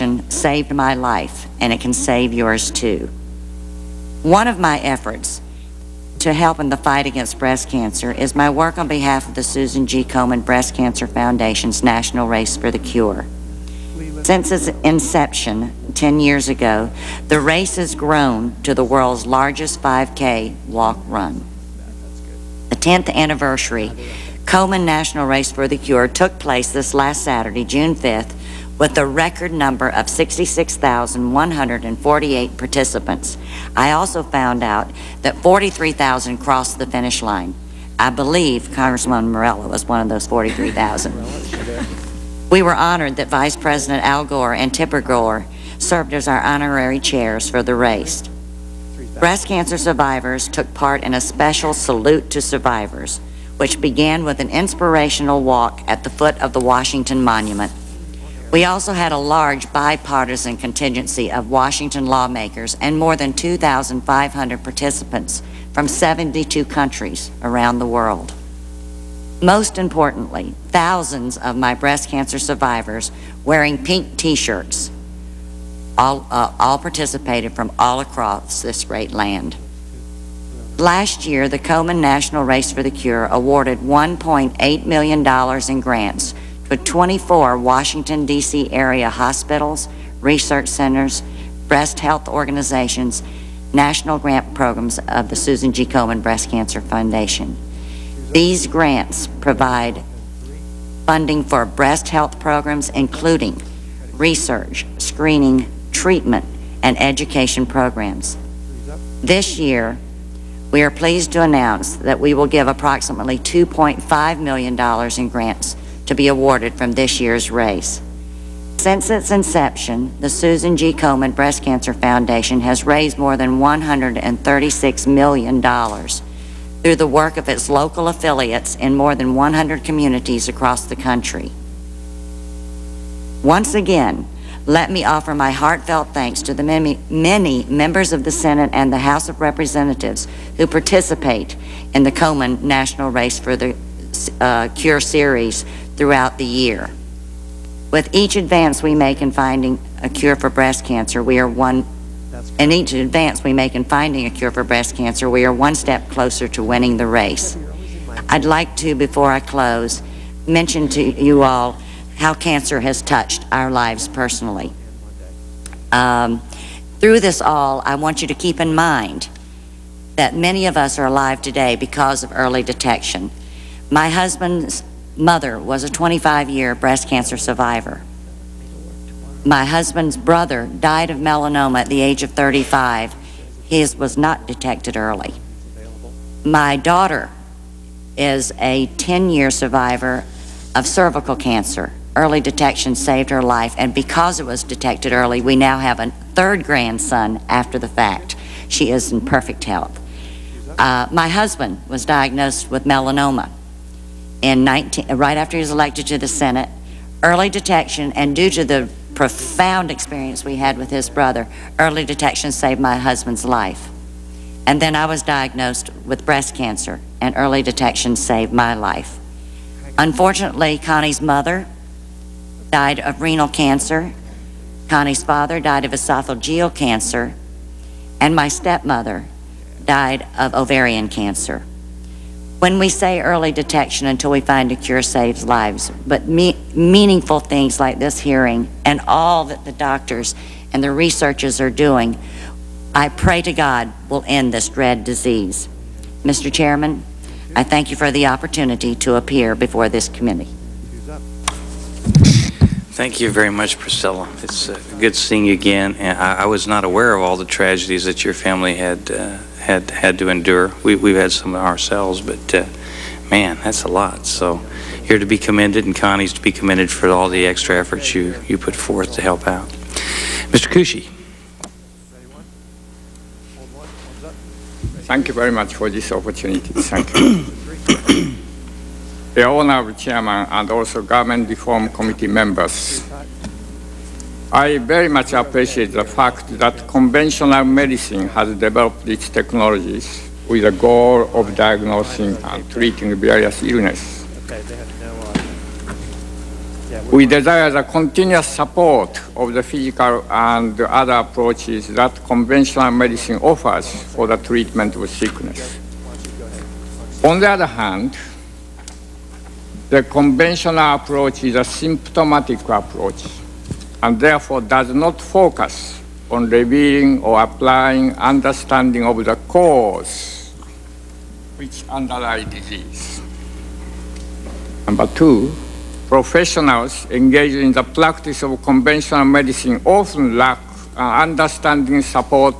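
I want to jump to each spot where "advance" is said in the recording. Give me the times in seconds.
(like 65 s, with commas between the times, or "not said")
148 s, 152 s.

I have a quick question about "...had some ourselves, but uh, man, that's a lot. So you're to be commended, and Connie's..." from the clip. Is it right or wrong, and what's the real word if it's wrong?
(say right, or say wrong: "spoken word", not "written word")
right.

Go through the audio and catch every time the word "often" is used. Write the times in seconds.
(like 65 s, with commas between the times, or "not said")
329 s.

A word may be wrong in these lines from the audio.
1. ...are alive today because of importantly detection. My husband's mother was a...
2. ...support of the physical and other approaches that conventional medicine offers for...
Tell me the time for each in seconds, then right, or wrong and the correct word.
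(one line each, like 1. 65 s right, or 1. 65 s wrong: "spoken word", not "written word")
1. 170 s wrong: "early", not "importantly"
2. 298 s right.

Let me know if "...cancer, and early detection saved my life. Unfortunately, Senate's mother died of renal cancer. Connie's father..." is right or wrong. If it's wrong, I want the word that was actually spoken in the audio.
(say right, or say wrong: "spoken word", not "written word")
wrong: "Connie", not "Senate".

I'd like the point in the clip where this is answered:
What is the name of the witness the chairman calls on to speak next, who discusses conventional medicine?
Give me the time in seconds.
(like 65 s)
270 s.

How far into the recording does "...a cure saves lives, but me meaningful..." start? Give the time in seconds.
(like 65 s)
234 s.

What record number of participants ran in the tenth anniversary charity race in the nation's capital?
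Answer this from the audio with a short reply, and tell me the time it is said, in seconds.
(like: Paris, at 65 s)
66,148, at 30 s.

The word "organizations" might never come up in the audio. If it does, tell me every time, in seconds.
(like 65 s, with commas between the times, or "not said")
92 s.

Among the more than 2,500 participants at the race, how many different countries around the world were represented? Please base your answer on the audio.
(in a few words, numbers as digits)
72.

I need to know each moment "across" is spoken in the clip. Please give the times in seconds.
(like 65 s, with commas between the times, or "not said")
78 s, 130 s.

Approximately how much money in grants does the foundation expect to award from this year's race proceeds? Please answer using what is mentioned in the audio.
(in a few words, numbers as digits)
$2.5 million.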